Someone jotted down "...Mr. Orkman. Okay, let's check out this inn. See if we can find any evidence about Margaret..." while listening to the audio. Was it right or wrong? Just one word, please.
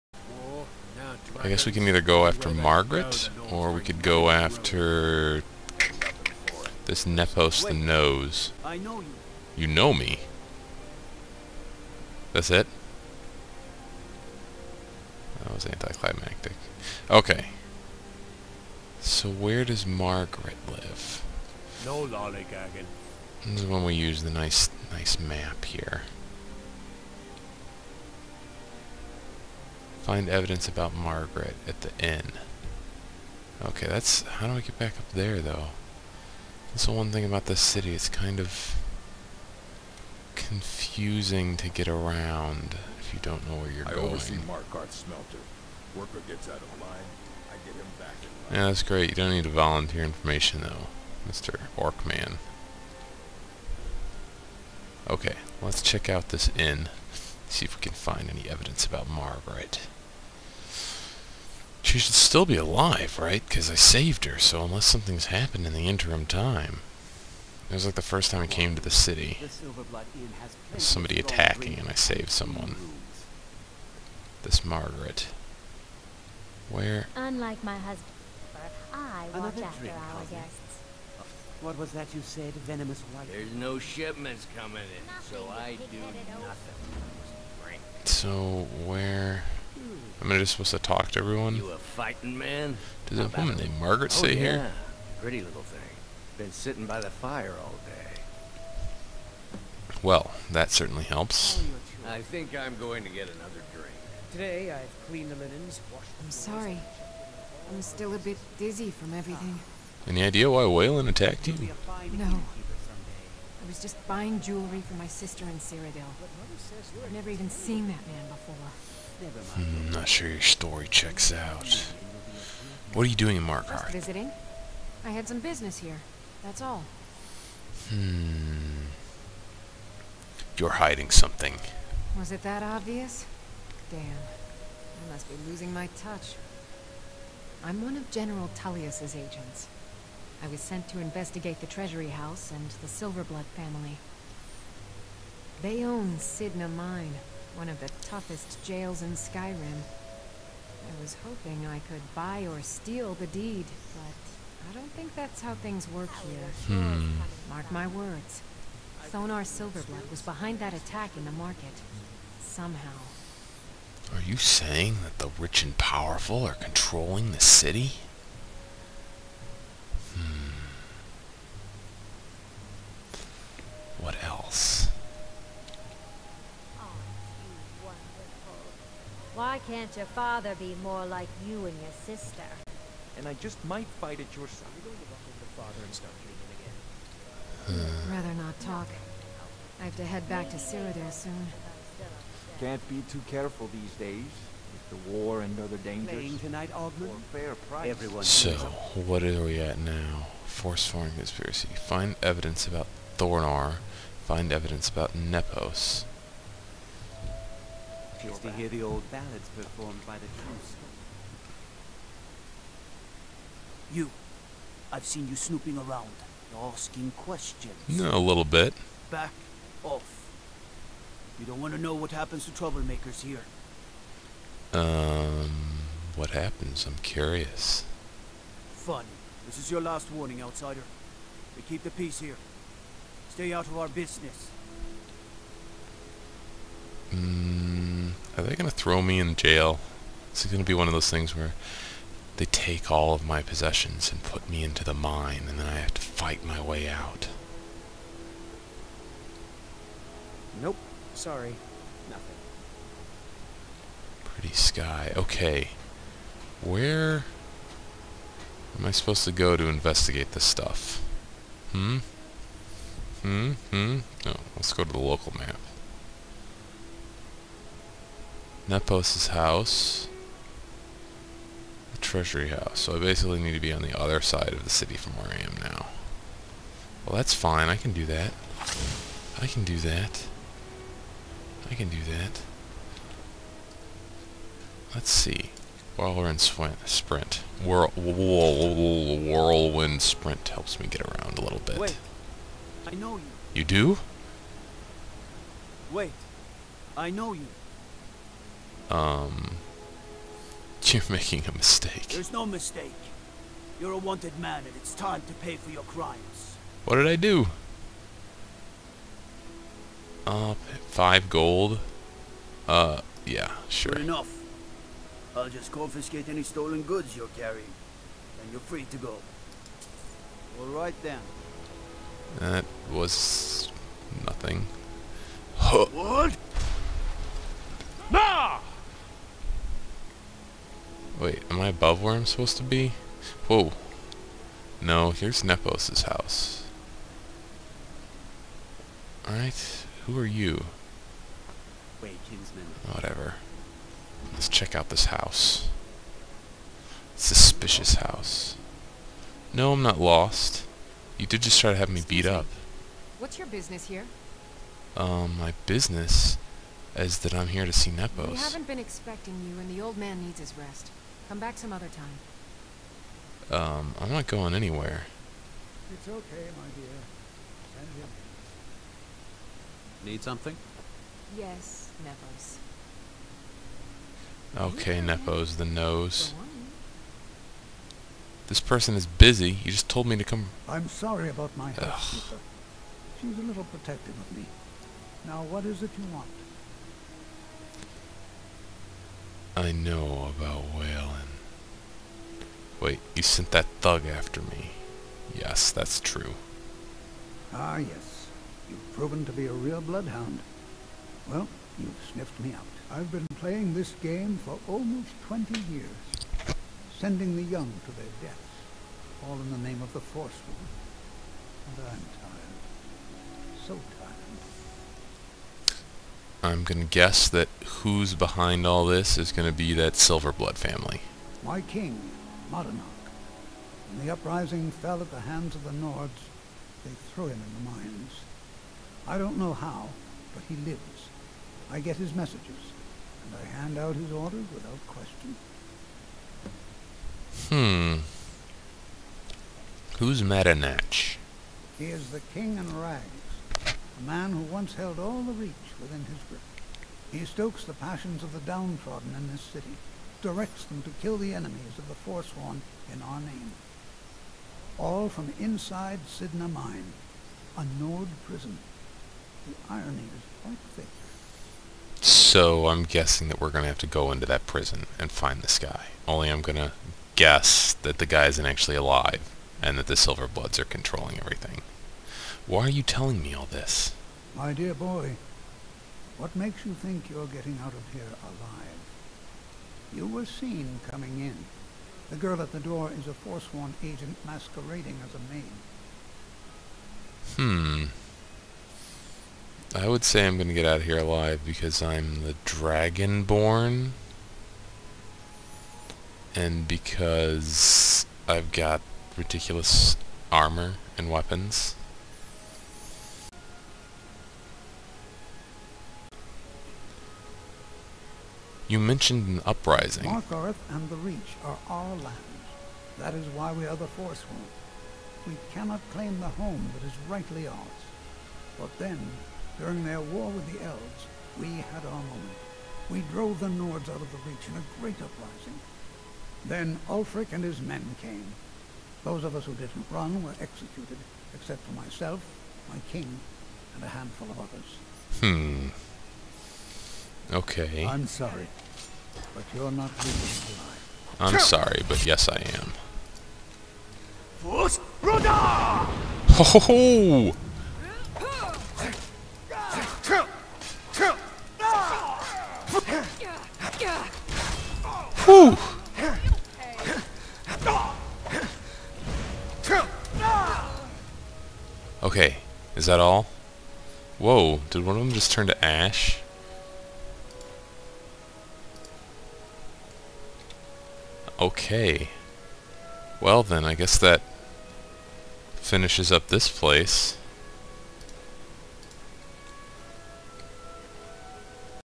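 right.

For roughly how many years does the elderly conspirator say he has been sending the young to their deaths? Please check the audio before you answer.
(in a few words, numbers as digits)
20.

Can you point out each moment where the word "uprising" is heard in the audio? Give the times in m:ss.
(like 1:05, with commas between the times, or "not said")
7:04, 8:29, 8:45.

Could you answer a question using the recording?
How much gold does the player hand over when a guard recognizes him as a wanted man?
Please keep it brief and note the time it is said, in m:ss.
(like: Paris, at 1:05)
5, at 5:10.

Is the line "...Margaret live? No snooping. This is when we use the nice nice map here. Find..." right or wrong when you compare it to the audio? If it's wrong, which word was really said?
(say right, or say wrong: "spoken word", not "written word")
wrong: "lollygagging", not "snooping".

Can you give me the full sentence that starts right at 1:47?
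I'm still a bit dizzy from everything.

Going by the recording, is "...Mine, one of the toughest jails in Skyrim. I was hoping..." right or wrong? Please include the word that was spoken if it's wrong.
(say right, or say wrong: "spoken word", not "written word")
right.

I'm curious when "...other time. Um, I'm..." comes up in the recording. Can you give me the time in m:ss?
6:01.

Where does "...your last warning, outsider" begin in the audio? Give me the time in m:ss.
3:49.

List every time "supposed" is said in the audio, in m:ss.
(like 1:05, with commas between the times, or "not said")
1:30, 4:18, 5:32.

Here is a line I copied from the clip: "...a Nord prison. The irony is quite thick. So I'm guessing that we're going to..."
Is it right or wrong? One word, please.
right.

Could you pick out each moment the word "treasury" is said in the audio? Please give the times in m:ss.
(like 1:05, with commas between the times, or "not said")
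2:21, 4:31.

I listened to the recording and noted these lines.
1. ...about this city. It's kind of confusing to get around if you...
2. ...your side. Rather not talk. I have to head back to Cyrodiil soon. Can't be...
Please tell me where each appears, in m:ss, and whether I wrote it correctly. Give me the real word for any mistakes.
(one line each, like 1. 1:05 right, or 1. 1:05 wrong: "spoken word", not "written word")
1. 0:37 right
2. 3:04 right.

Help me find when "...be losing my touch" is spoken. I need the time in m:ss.
2:15.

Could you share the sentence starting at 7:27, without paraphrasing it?
He stokes the passions of the downtrodden in this city, directs them to kill the enemies of the Forsworn in our name.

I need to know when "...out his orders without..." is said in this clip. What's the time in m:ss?
7:13.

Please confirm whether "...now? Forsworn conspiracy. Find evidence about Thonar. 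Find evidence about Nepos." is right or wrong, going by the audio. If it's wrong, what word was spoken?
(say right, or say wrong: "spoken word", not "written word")
right.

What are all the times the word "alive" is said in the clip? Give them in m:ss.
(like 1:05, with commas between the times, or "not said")
1:02, 7:48, 7:58, 8:10, 9:01.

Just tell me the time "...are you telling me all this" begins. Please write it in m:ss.
7:52.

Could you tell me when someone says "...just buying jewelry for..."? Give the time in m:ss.
1:53.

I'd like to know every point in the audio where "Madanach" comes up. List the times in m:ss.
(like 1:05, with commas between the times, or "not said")
7:02, 7:20.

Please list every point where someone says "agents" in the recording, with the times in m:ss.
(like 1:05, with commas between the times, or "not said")
2:19, 8:03.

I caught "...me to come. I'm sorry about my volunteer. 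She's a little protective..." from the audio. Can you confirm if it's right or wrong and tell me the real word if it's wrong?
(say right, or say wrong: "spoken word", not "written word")
wrong: "housekeeper", not "volunteer".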